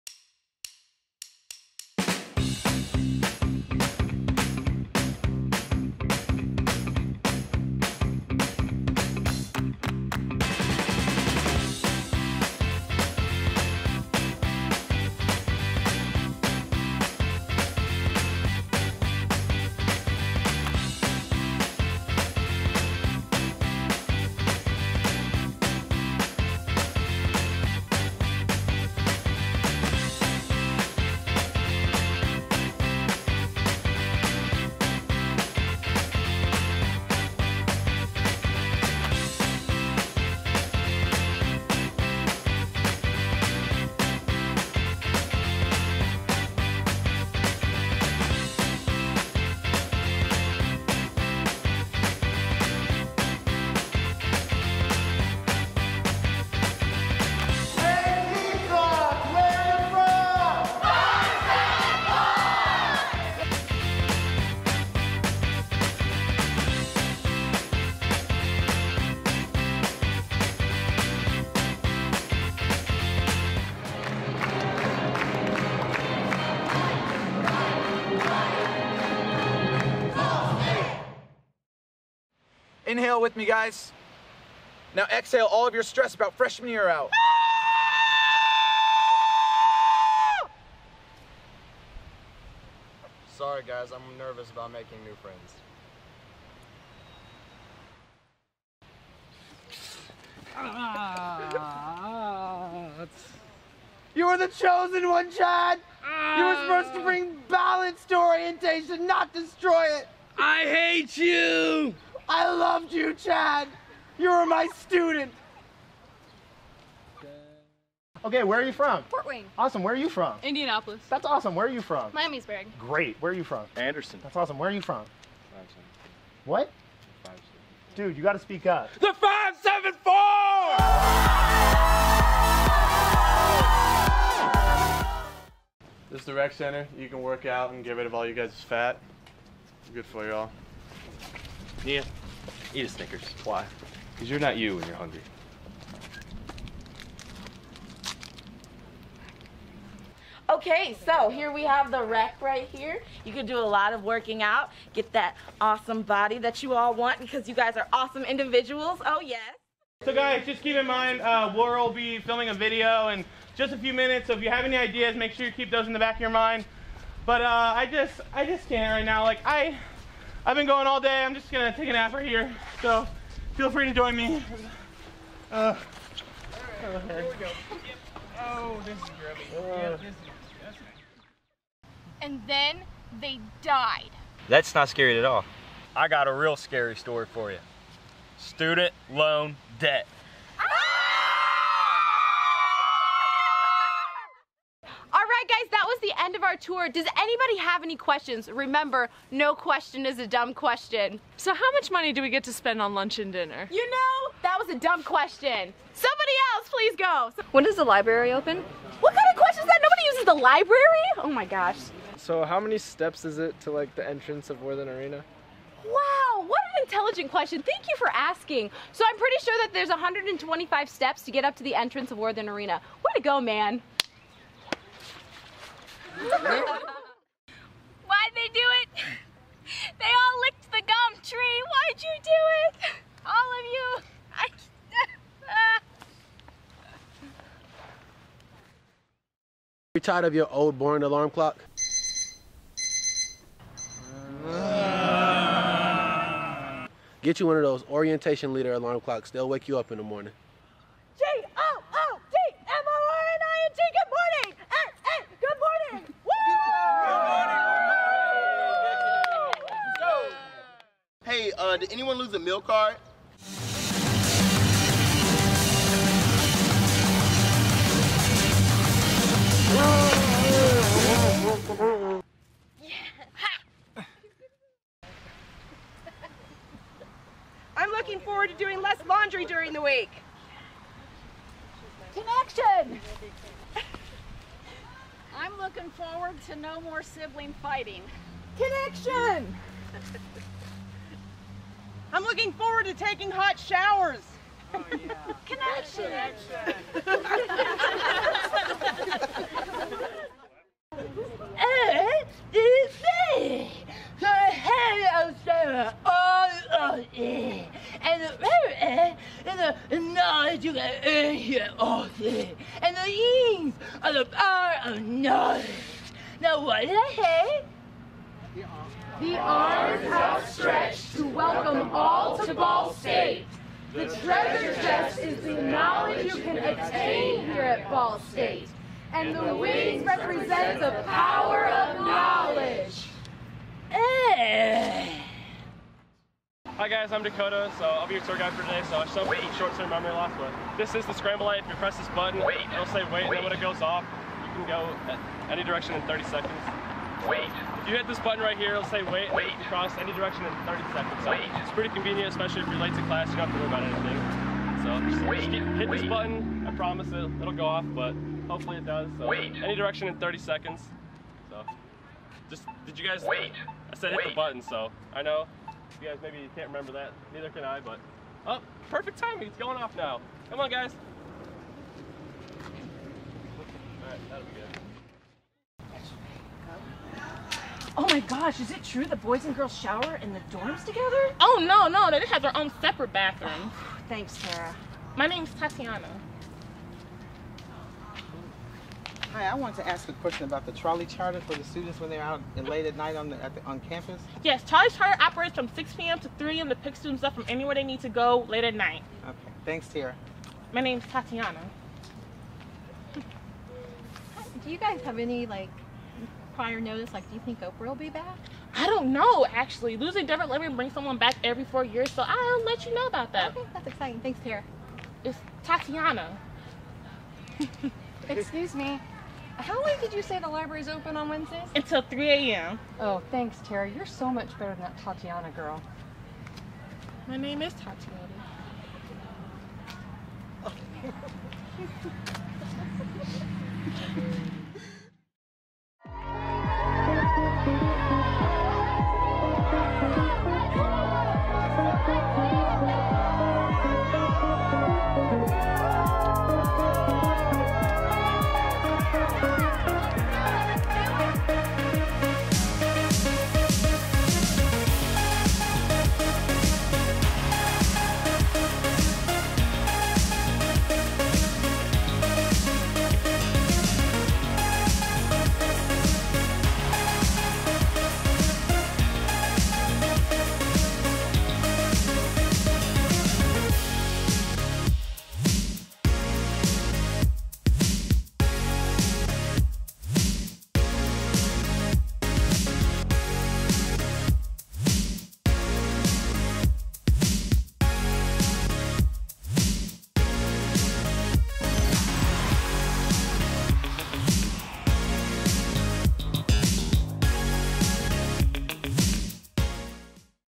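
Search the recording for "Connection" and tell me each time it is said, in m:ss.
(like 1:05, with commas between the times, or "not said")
4:42, 4:48.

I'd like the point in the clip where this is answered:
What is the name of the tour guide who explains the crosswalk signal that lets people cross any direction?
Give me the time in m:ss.
5:37.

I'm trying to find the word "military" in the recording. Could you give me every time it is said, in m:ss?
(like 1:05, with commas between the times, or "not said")
not said.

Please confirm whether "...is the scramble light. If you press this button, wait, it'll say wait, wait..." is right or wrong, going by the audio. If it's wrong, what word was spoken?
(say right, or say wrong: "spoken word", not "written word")
right.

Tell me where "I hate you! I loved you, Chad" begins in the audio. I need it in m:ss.
1:50.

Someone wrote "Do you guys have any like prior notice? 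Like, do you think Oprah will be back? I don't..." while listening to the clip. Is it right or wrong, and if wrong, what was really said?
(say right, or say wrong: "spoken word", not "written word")
right.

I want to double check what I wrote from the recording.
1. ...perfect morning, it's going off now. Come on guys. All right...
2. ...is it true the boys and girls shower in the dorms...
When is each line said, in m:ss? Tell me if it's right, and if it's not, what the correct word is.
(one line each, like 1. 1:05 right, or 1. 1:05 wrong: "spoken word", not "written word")
1. 6:08 wrong: "timing", not "morning"
2. 6:18 right.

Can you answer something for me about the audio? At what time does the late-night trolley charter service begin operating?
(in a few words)
6 p.m.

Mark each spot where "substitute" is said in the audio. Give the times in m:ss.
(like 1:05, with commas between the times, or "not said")
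not said.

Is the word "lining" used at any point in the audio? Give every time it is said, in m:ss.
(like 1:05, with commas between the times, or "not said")
not said.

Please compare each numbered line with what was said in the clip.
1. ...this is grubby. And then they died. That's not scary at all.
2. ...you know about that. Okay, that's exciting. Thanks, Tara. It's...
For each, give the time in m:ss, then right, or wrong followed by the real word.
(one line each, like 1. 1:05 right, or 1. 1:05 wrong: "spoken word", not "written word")
1. 2:58 right
2. 6:52 right.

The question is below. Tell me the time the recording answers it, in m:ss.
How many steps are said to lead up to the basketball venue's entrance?
3:39.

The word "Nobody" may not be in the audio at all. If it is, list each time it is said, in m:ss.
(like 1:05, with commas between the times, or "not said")
3:29.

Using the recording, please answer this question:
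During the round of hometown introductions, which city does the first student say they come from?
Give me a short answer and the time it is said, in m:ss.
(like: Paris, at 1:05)
Fort Wayne, at 1:59.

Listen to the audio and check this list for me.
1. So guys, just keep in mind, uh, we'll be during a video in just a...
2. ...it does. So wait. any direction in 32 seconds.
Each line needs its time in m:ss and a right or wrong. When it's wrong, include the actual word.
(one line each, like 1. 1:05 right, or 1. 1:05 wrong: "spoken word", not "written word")
1. 2:40 wrong: "filming", not "during"
2. 5:58 wrong: "30", not "32".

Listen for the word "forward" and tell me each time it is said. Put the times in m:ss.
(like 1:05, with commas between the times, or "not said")
4:38, 4:45.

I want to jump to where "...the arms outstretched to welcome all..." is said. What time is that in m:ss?
5:19.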